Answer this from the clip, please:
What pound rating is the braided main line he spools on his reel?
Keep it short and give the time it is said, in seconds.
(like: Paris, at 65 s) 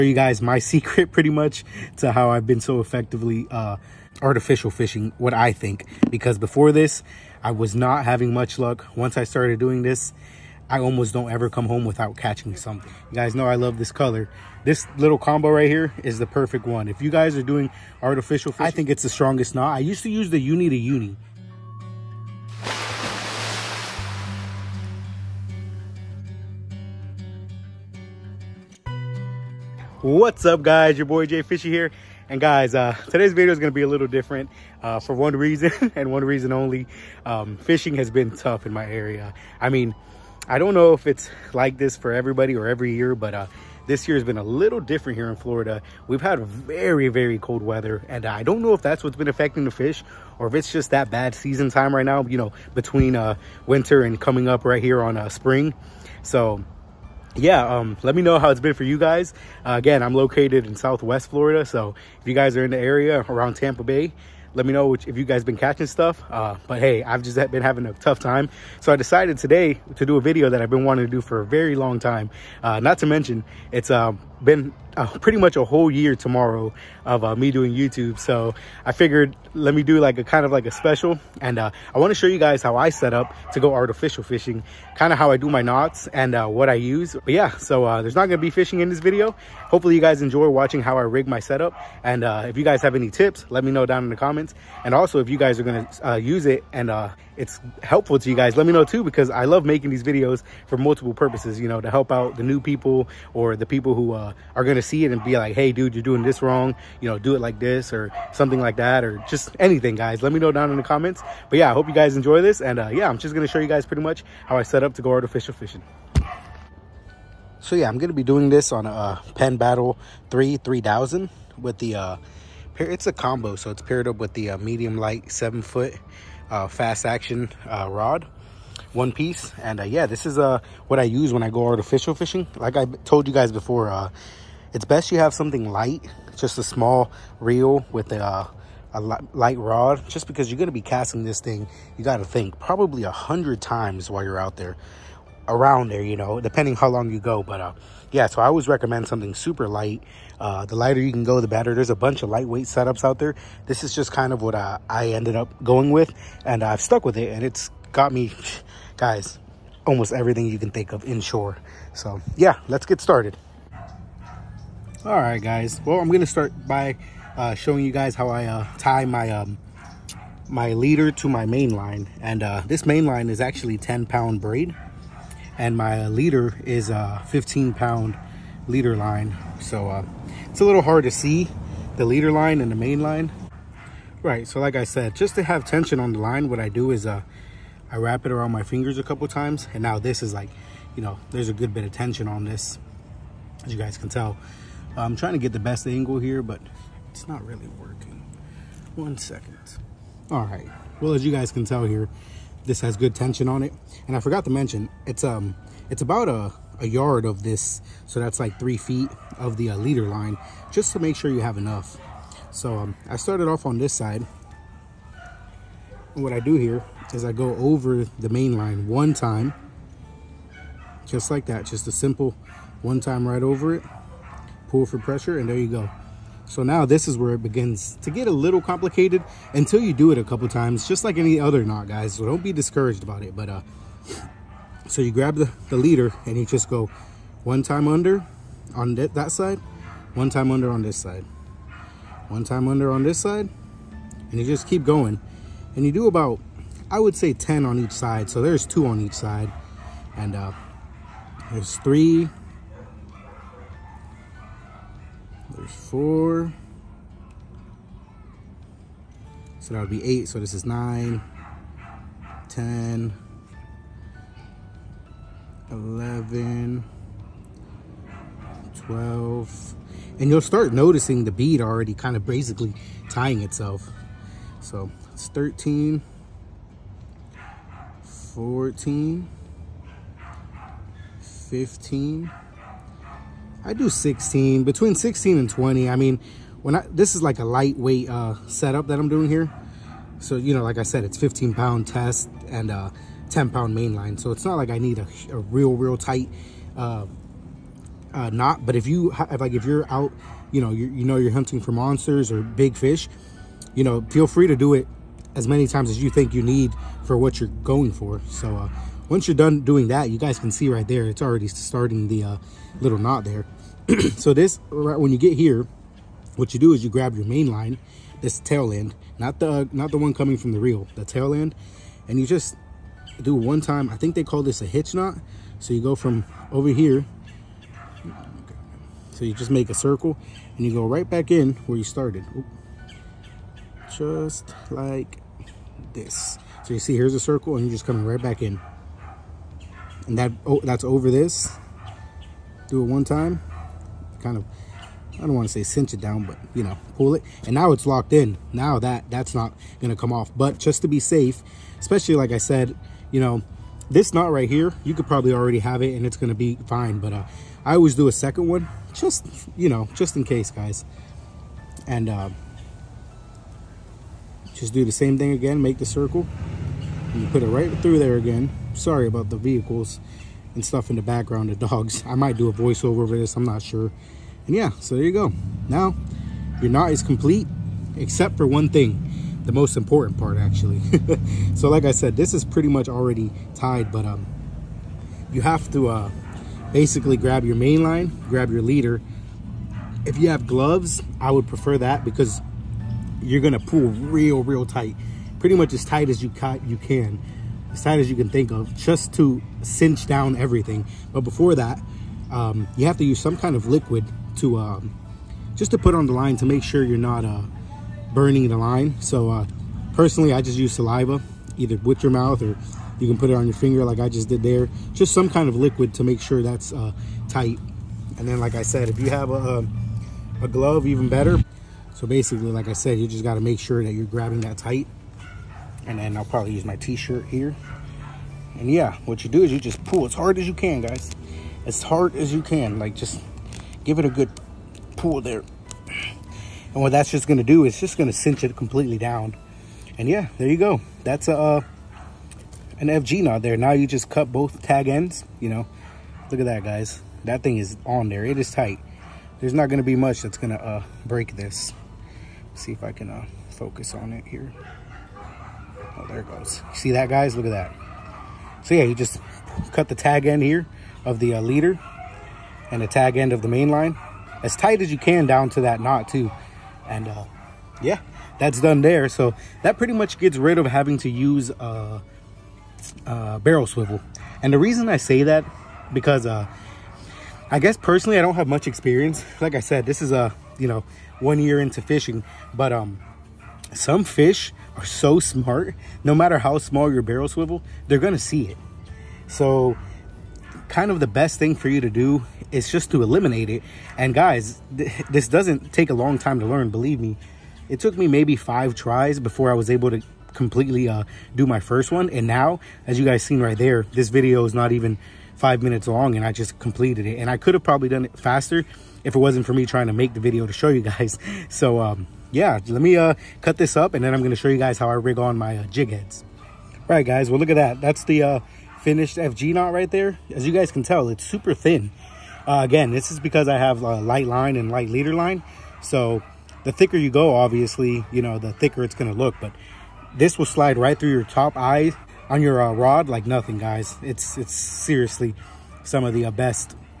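10 pound, at 173 s.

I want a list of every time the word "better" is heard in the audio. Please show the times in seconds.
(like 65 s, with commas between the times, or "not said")
151 s, 421 s.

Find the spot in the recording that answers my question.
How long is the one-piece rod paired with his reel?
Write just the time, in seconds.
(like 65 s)
125 s.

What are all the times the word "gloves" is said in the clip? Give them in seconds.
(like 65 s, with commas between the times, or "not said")
390 s, 420 s.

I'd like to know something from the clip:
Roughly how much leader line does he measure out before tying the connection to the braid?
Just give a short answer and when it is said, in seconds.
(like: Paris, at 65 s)
a yard, at 206 s.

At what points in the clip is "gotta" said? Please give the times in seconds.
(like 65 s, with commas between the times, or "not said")
142 s.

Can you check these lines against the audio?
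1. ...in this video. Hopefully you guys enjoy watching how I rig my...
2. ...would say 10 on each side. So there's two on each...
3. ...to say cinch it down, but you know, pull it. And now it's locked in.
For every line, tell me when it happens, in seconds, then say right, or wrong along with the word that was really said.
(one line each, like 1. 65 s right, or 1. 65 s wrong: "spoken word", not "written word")
1. 88 s right
2. 246 s right
3. 345 s right.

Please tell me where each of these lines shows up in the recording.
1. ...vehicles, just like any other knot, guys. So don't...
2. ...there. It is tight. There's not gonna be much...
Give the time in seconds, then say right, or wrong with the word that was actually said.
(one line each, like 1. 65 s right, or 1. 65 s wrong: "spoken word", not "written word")
1. 230 s wrong: "times", not "vehicles"
2. 448 s right.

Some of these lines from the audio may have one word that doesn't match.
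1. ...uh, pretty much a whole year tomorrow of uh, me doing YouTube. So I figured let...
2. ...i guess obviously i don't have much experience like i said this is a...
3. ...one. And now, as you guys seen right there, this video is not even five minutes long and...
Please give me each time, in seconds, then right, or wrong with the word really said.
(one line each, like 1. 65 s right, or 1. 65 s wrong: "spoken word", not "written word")
1. 74 s right
2. 477 s wrong: "personally", not "obviously"
3. 501 s right.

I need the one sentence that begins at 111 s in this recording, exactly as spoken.
But yeah, I hope you guys enjoy this.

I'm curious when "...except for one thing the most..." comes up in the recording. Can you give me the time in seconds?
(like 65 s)
377 s.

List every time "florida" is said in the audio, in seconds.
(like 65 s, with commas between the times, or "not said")
45 s, 61 s.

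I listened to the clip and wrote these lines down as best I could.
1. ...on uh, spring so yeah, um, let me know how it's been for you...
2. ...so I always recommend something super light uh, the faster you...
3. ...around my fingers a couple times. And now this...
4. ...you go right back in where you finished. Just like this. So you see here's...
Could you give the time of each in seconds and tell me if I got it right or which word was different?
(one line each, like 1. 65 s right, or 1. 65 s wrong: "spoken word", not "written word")
1. 55 s right
2. 148 s wrong: "lighter", not "faster"
3. 188 s right
4. 330 s wrong: "started", not "finished".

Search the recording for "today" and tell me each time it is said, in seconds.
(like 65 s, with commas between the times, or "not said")
33 s, 69 s.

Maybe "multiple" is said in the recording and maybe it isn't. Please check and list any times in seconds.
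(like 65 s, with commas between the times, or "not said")
100 s.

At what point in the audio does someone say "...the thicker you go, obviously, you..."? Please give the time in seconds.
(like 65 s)
526 s.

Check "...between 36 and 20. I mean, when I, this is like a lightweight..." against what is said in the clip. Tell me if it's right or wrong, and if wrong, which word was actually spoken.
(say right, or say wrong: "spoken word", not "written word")
wrong: "16", not "36".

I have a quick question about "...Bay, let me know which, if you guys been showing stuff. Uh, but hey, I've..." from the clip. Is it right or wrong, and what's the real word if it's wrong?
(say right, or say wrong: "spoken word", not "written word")
wrong: "catching", not "showing".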